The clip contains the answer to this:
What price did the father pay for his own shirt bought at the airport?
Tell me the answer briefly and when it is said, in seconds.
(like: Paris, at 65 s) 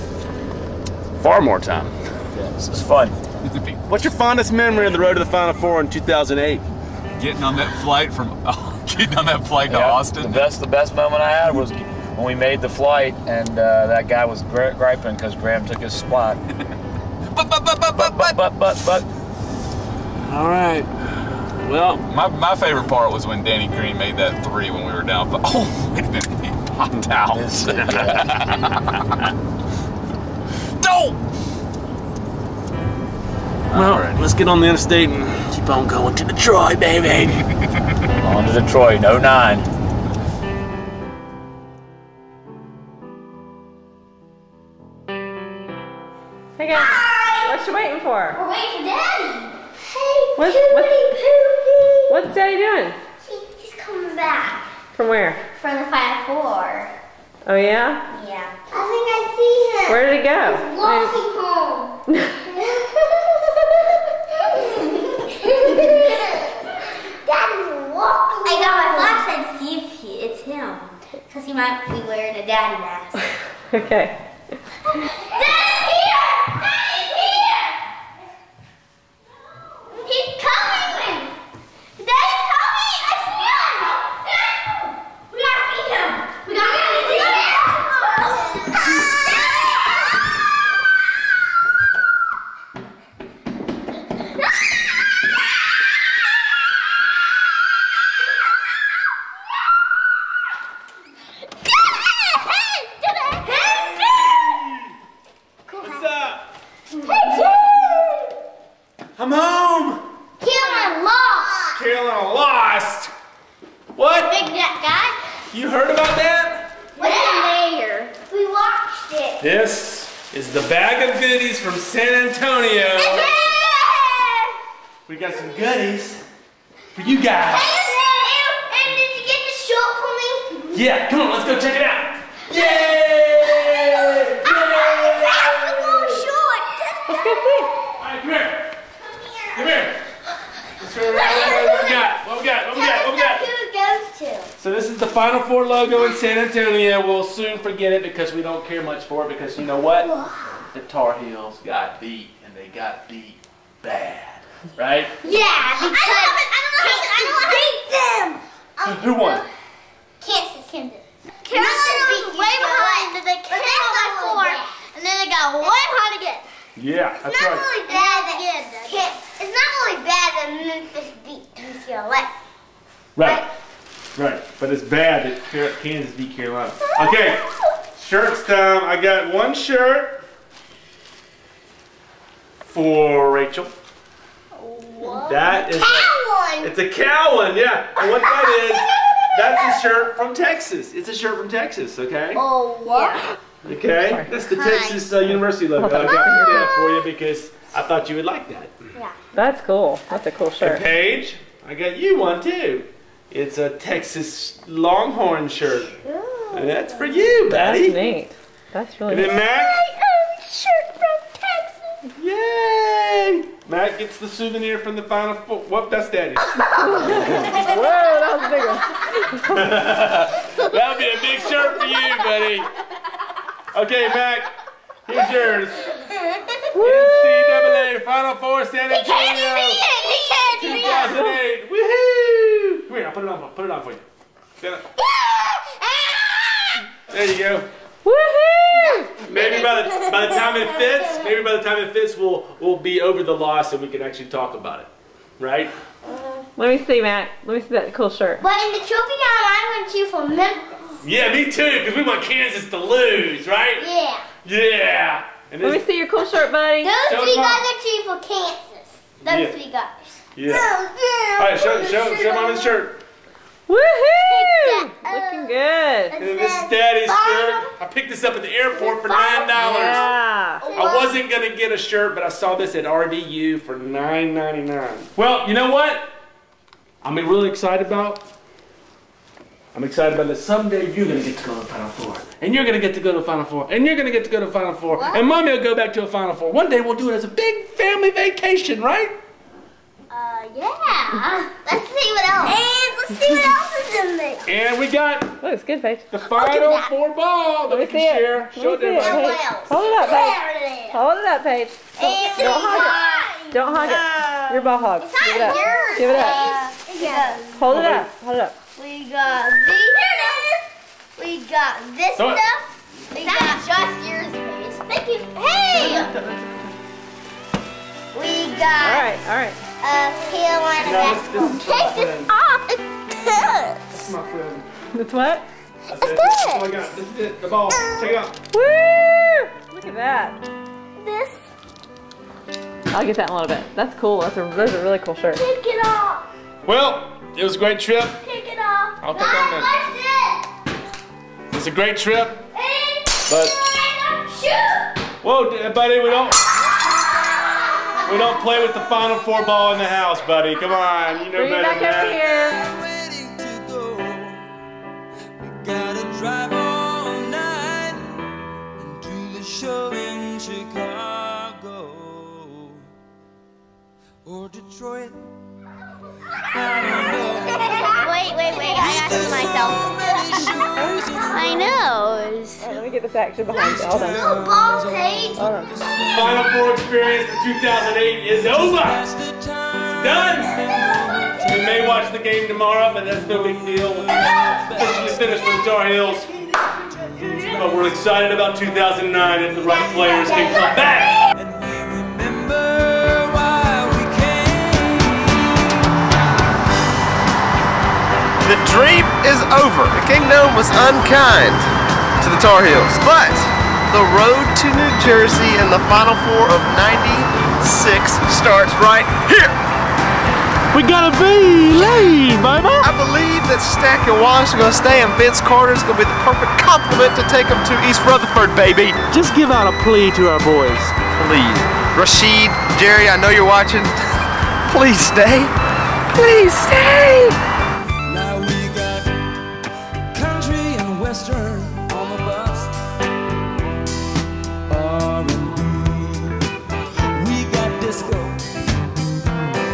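$9.99, at 273 s.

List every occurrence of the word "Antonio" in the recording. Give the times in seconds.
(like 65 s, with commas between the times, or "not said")
146 s, 228 s.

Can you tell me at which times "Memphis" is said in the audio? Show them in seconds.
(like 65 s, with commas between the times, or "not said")
170 s, 250 s.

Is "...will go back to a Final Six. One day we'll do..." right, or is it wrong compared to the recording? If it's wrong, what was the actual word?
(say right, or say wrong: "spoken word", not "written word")
wrong: "Four", not "Six".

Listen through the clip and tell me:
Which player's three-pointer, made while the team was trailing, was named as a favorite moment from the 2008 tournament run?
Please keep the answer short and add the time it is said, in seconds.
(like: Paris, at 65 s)
Danny Green, at 23 s.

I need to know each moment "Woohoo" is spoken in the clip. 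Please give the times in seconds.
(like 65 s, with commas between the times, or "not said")
231 s, 238 s, 263 s.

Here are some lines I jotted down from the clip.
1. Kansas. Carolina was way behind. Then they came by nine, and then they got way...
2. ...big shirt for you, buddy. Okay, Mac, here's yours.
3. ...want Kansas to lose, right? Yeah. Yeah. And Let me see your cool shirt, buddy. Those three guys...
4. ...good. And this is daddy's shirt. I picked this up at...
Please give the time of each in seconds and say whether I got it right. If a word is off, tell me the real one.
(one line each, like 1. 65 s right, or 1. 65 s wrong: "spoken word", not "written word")
1. 160 s wrong: "four", not "nine"
2. 221 s right
3. 252 s right
4. 265 s right.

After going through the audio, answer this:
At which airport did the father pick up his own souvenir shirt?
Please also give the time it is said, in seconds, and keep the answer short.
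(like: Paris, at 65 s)
RDU, at 272 s.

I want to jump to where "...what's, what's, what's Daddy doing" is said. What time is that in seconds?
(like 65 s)
50 s.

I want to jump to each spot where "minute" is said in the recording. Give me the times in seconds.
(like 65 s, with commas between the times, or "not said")
26 s.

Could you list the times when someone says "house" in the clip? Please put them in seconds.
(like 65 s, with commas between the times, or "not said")
349 s.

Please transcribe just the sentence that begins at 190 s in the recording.
It's a shirt from Texas, okay?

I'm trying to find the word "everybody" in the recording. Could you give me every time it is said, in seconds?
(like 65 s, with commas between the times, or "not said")
298 s.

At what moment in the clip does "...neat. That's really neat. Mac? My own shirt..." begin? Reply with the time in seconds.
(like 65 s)
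207 s.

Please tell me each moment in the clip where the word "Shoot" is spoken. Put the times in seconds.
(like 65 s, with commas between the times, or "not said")
344 s.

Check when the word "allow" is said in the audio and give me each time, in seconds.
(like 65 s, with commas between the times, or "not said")
not said.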